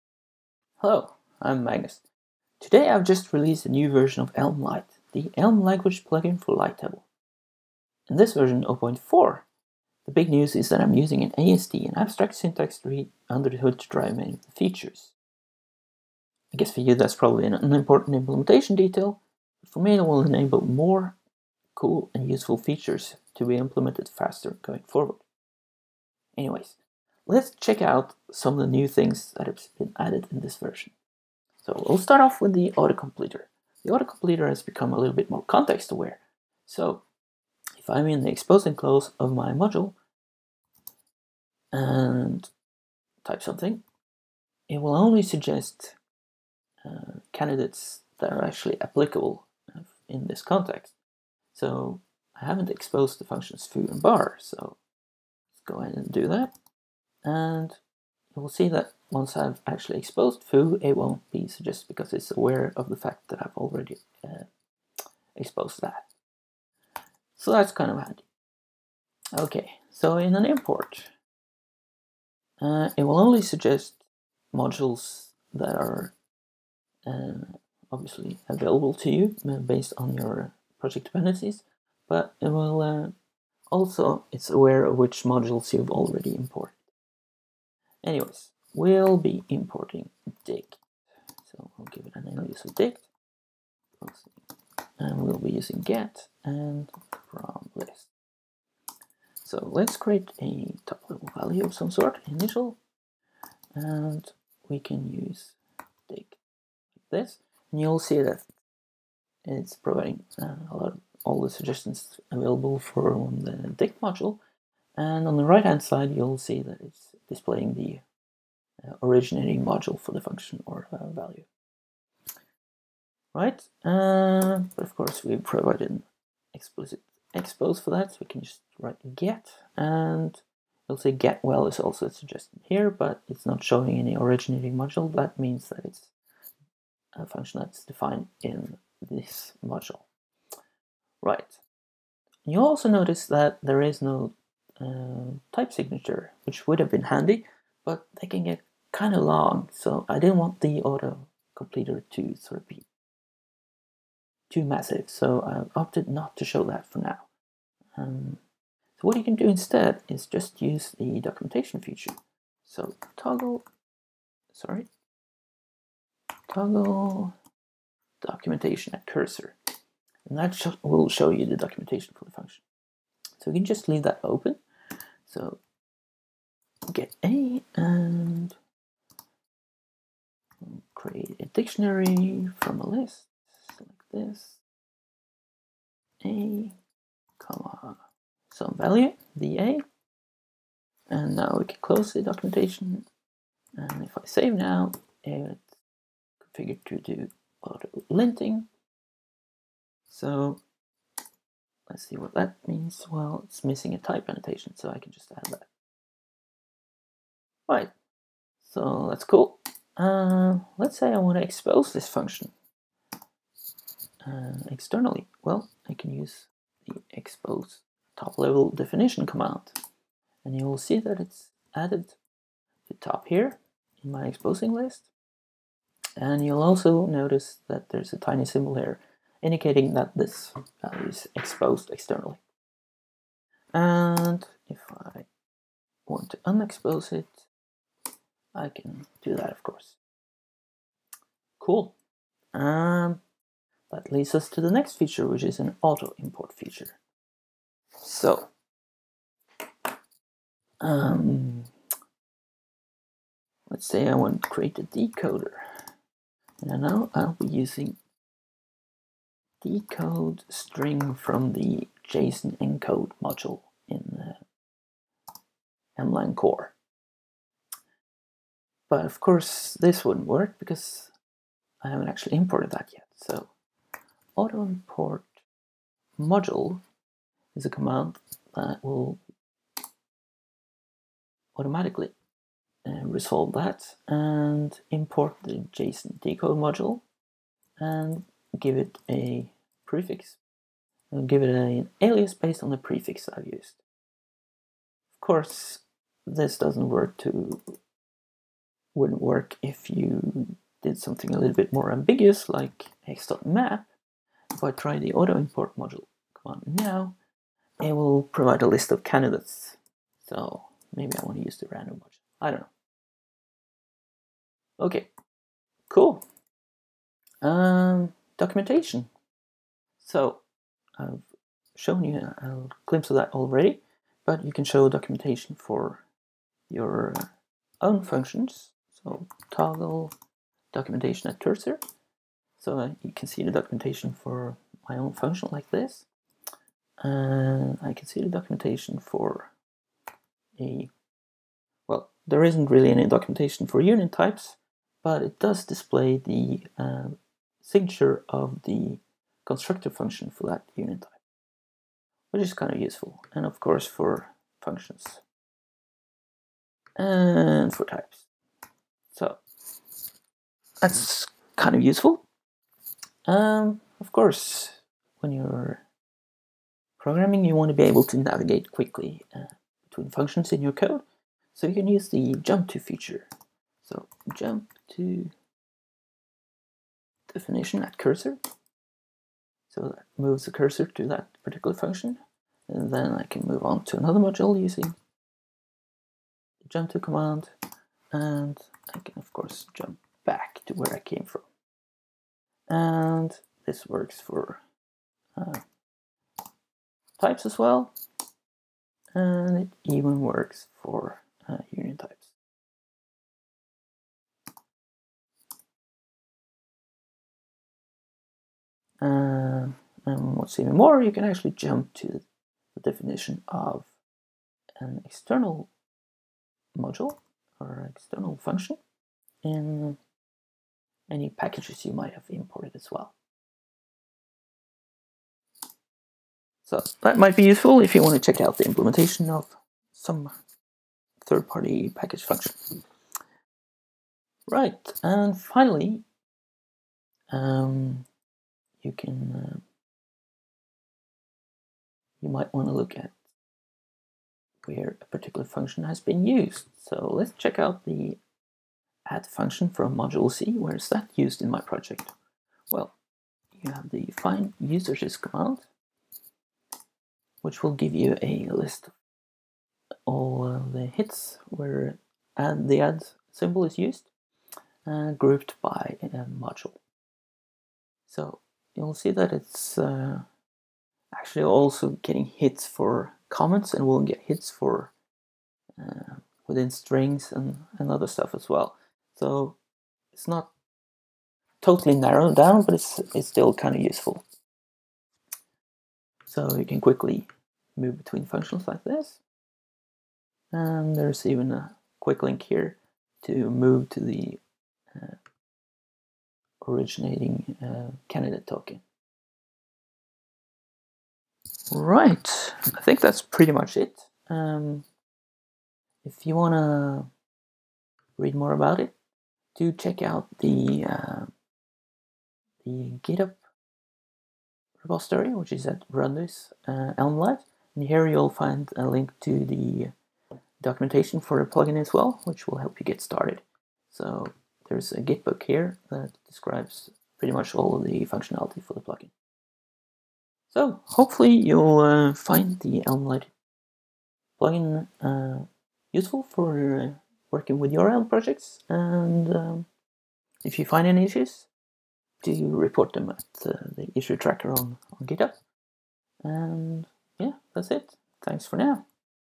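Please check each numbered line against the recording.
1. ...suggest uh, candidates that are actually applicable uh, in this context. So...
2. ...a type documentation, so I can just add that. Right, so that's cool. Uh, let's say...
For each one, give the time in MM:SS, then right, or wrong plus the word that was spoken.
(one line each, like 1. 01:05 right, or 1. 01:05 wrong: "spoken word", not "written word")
1. 00:45 right
2. 03:23 wrong: "annotation", not "documentation".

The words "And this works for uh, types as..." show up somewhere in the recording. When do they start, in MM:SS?
06:32.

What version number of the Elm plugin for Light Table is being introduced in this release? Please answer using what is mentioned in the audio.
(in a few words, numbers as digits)
0.4.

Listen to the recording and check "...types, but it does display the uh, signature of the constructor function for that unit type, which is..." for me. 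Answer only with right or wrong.
right.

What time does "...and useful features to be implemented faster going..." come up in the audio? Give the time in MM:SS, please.
00:22.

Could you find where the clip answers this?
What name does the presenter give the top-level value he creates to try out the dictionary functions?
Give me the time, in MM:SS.
01:42.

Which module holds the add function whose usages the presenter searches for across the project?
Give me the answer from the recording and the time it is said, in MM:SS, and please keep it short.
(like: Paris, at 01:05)
module C, at 07:29.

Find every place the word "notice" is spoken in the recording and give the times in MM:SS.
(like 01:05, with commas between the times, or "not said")
02:22, 03:47.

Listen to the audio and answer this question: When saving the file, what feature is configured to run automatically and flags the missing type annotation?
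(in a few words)
auto linting.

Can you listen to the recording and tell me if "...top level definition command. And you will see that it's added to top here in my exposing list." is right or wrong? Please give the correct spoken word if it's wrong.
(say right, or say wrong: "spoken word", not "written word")
right.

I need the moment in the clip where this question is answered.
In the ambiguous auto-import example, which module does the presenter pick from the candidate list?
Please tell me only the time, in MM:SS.
05:11.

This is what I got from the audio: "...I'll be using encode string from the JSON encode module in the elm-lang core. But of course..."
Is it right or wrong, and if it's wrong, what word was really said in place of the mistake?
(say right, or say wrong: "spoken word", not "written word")
wrong: "decode", not "encode".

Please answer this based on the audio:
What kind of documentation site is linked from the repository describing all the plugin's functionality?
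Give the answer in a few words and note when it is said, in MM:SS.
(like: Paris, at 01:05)
GitBook, at 08:45.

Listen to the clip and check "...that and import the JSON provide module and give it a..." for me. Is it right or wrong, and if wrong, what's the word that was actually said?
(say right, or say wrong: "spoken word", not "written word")
wrong: "decode", not "provide".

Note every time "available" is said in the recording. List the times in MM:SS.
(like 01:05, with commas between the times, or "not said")
01:18, 01:52.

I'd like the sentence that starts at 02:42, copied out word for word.
So toggle, sorry, toggle documentation at cursor, and that sh will show you the documentation for the function.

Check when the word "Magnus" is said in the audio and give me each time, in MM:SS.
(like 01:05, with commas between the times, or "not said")
00:01.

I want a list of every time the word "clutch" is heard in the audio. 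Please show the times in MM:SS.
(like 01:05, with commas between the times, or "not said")
not said.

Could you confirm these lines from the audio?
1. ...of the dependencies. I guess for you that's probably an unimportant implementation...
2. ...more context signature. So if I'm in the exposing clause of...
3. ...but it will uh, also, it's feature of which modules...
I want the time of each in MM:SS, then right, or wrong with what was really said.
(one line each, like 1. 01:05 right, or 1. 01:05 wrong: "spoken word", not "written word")
1. 00:14 wrong: "features", not "dependencies"
2. 00:35 wrong: "aware", not "signature"
3. 01:22 wrong: "aware", not "feature".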